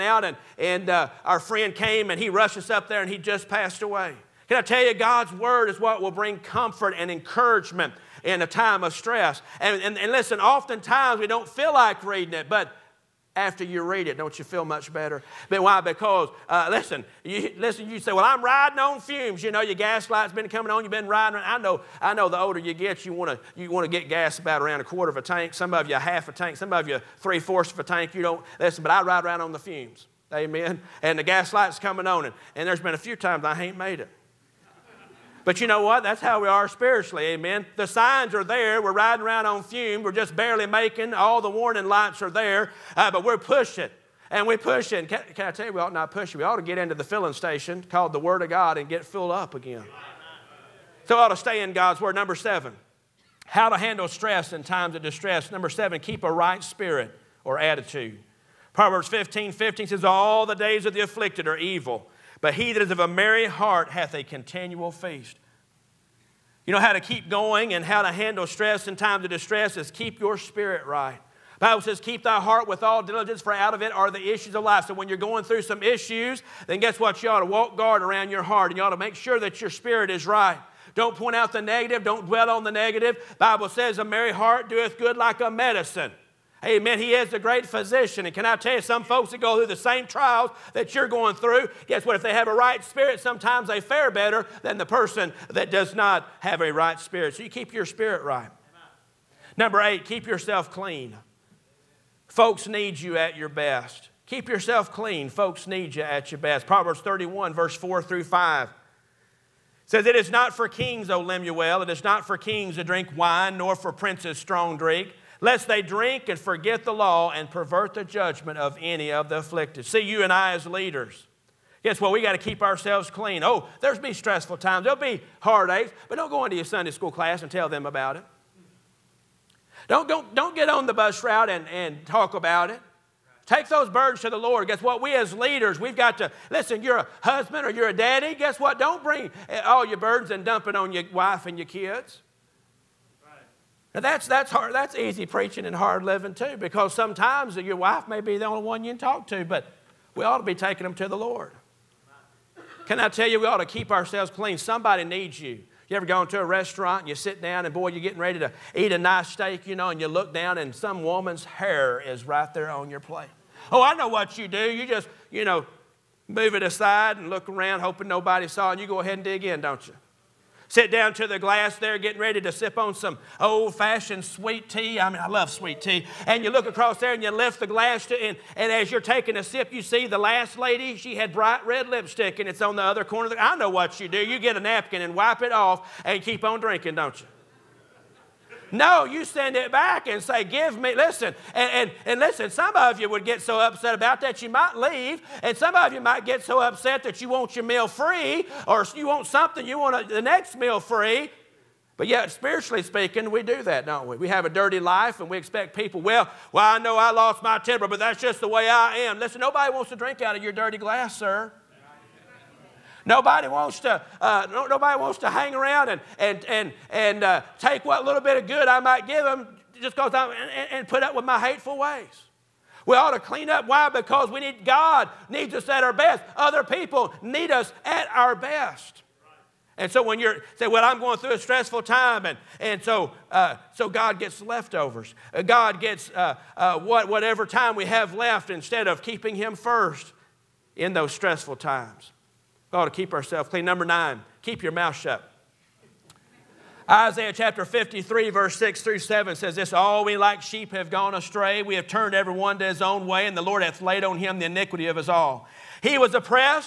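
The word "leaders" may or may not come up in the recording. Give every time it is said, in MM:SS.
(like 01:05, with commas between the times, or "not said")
02:00, 02:15.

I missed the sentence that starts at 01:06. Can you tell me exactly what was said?
You know how to keep going and how to handle stress in times of distress is keep your spirit right.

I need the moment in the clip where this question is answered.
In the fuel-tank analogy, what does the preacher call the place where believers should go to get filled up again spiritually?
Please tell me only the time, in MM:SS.
00:48.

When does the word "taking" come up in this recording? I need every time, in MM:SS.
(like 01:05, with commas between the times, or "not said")
02:30, 02:58.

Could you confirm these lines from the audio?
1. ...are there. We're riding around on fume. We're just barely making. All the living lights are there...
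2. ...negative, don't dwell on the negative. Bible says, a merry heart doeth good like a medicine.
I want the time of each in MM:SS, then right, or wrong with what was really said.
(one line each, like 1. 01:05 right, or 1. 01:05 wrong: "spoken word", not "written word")
1. 00:38 wrong: "warning", not "living"
2. 01:21 right.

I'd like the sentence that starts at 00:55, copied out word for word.
Number seven, keep a right spirit or attitude.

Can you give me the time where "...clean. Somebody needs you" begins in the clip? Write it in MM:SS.
02:34.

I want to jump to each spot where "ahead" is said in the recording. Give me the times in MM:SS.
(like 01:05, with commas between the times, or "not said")
02:49.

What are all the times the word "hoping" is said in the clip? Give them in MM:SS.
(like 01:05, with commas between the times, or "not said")
02:47.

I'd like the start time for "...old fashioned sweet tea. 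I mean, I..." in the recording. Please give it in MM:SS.
02:53.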